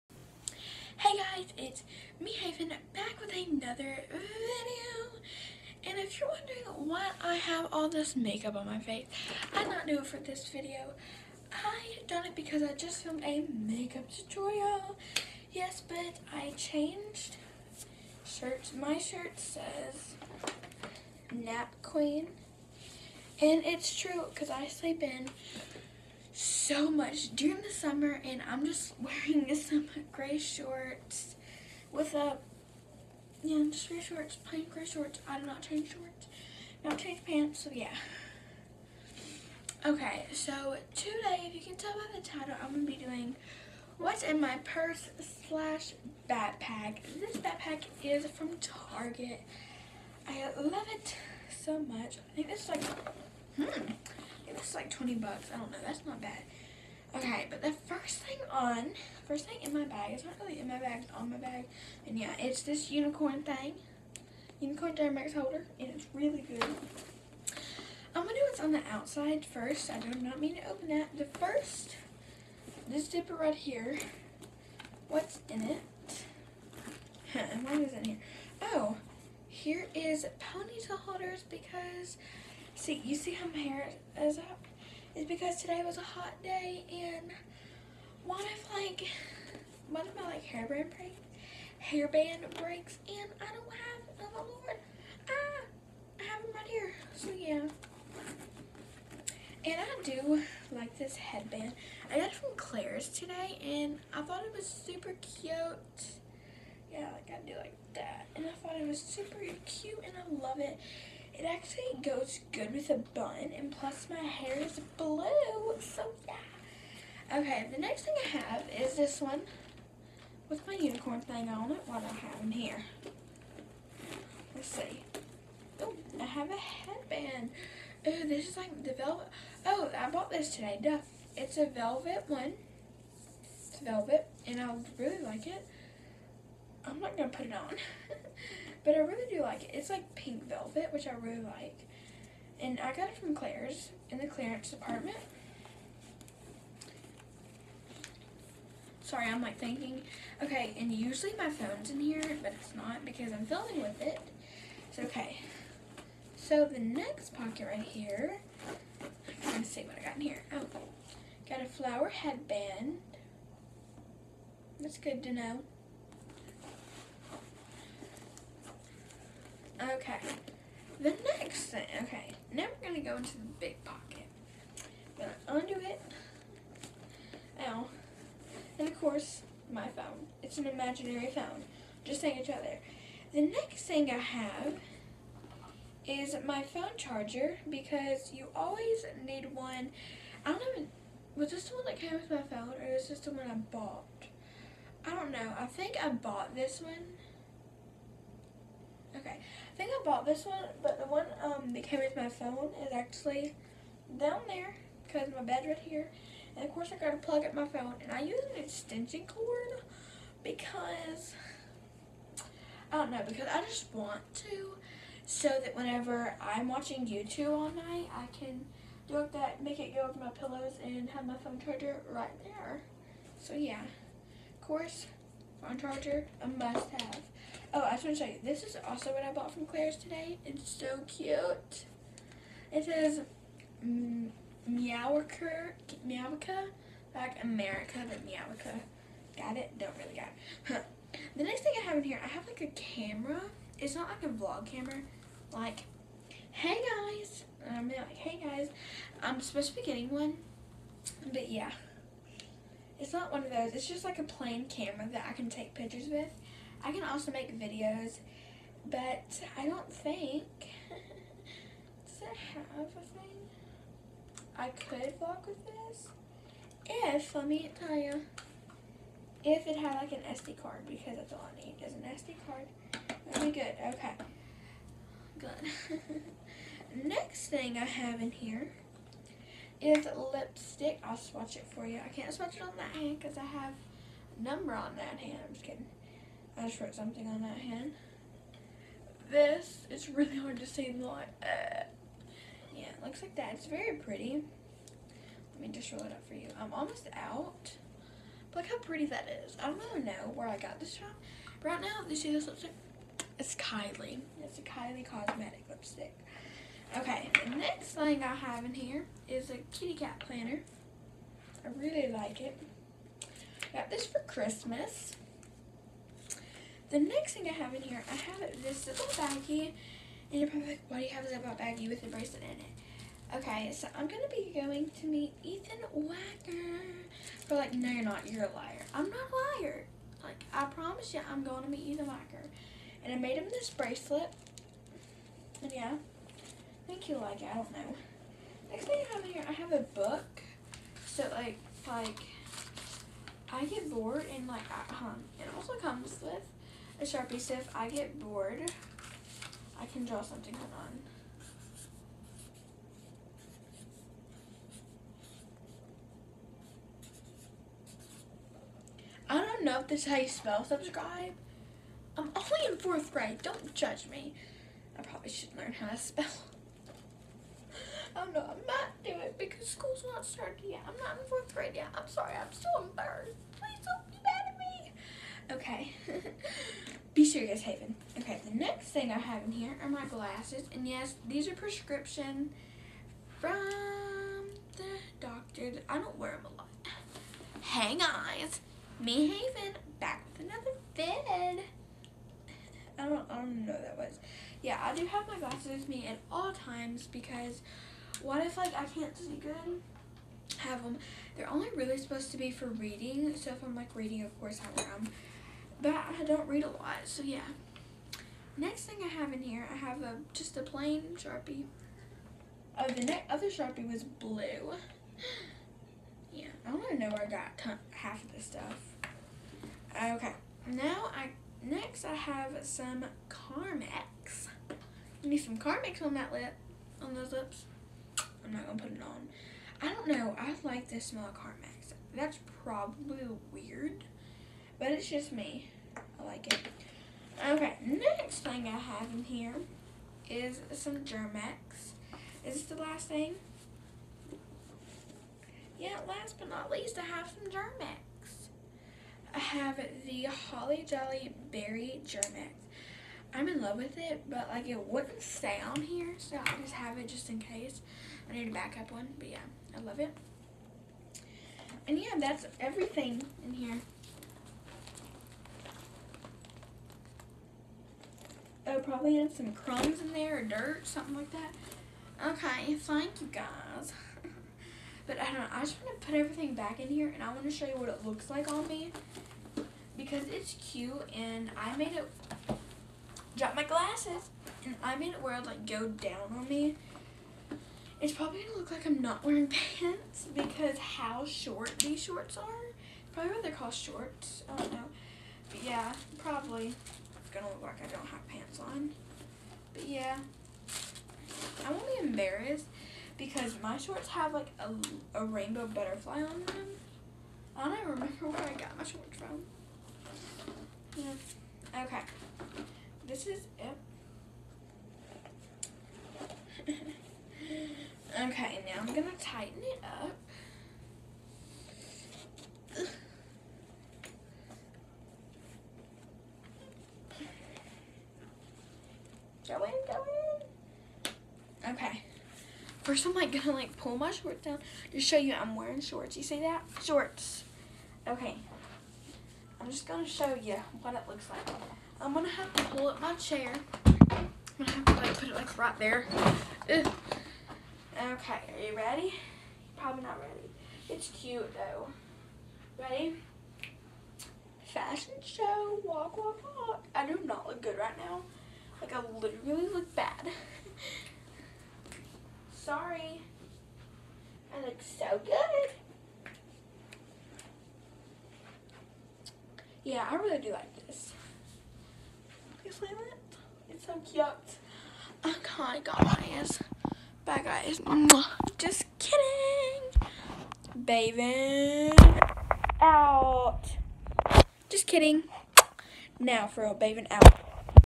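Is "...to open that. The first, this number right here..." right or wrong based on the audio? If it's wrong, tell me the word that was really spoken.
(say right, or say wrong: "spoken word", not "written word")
wrong: "zipper", not "number".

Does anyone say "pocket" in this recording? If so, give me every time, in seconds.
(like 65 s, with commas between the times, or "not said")
157 s, 173 s.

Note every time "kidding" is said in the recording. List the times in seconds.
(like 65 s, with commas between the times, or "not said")
285 s, 578 s, 584 s.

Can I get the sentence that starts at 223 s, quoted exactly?
So yeah, of course, phone charger, a must have.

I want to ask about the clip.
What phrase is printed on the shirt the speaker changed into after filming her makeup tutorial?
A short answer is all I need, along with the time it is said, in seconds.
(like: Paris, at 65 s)
Nap Queen, at 21 s.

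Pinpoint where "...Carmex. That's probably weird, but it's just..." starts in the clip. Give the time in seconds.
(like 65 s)
431 s.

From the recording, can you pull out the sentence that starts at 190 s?
I don't even, was this the one that came with my phone or is this the one I bought?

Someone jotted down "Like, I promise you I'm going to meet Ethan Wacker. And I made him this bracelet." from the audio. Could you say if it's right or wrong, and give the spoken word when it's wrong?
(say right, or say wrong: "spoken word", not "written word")
right.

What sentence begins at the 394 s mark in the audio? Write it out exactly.
Yeah, I do have my glasses with me at all times because what if like I can't see good?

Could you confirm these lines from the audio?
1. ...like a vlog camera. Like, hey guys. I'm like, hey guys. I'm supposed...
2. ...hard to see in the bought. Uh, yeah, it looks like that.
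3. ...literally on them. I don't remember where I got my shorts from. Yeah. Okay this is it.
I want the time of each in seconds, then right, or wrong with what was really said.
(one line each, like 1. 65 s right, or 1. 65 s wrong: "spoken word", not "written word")
1. 244 s right
2. 290 s wrong: "light", not "bought"
3. 505 s wrong: "butterfly", not "literally".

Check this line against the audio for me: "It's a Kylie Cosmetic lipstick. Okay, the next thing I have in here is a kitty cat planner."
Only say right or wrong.
right.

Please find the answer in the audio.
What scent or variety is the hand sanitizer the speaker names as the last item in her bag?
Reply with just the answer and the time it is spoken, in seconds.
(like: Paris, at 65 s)
Holly Jolly Berry, at 450 s.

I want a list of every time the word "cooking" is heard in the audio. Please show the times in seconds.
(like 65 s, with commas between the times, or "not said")
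not said.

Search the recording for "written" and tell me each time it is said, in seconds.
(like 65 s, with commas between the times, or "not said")
not said.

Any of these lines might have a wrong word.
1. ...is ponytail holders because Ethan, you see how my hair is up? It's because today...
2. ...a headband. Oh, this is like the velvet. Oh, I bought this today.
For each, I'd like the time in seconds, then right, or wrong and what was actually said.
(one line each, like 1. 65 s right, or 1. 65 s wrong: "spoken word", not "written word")
1. 79 s wrong: "See", not "Ethan"
2. 126 s right.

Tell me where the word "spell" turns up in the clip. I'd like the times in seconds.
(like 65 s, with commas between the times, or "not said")
360 s, 365 s.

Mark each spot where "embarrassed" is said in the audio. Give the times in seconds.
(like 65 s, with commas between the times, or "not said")
372 s, 502 s.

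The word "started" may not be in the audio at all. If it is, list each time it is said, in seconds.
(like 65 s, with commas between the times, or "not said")
370 s.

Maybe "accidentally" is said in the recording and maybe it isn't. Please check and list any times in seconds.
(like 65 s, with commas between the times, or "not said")
not said.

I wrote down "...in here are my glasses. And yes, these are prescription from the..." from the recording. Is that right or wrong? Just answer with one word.
right.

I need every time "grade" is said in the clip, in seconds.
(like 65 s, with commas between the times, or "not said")
363 s, 371 s.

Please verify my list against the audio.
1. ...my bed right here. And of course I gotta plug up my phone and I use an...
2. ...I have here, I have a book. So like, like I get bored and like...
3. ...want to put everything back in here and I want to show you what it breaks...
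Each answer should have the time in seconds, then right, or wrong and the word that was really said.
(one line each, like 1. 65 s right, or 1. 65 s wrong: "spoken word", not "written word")
1. 205 s right
2. 339 s right
3. 475 s wrong: "looks", not "breaks".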